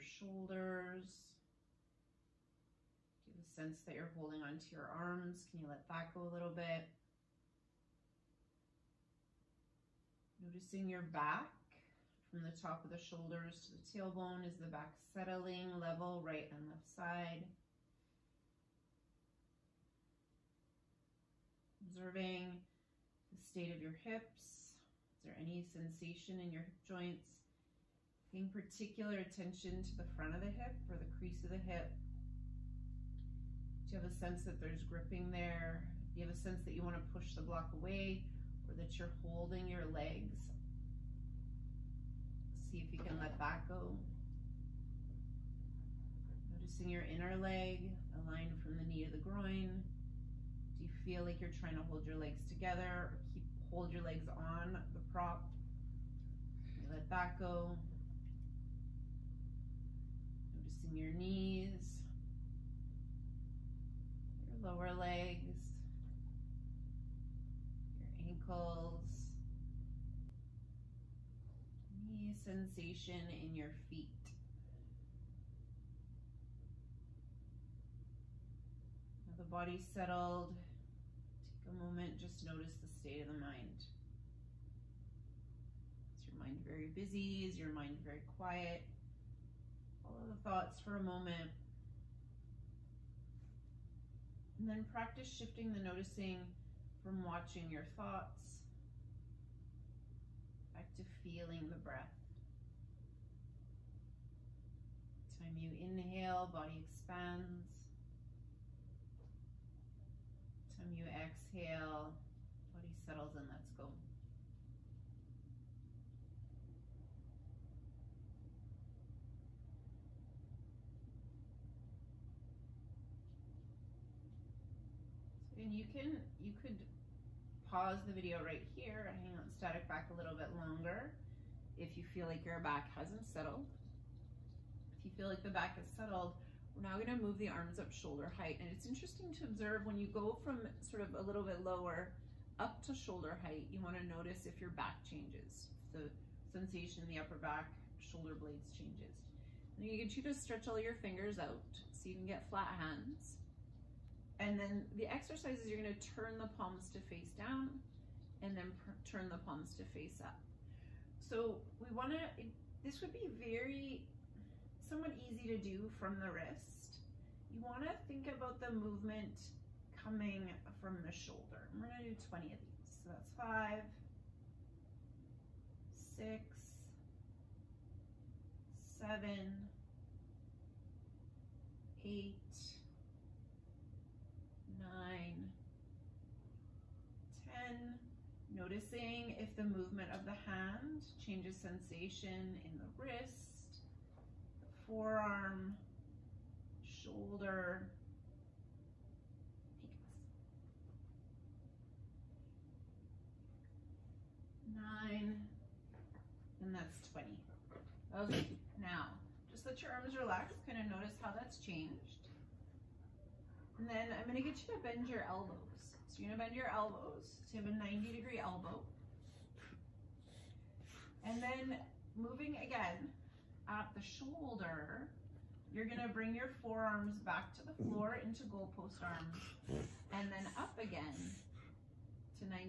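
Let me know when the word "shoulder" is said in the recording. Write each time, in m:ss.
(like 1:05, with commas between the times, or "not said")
0:00, 0:13, 2:17, 2:22, 2:27, 2:51, 3:16, 3:44.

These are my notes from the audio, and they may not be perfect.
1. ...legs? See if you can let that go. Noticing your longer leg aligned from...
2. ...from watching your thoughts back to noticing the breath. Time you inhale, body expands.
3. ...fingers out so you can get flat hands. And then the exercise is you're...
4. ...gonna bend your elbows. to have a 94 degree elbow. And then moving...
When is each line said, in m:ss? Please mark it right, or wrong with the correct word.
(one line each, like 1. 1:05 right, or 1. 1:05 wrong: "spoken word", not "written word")
1. 0:39 wrong: "inner", not "longer"
2. 1:37 wrong: "feeling", not "noticing"
3. 2:30 right
4. 3:36 wrong: "90", not "94".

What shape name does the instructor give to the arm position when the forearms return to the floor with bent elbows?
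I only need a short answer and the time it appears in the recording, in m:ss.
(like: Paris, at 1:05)
goalpost arms, at 3:48.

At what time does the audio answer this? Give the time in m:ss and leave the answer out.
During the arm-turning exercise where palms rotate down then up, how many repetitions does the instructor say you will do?
2:52.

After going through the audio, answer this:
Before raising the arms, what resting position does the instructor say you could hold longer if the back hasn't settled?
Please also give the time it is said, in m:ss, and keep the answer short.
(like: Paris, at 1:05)
static back, at 2:09.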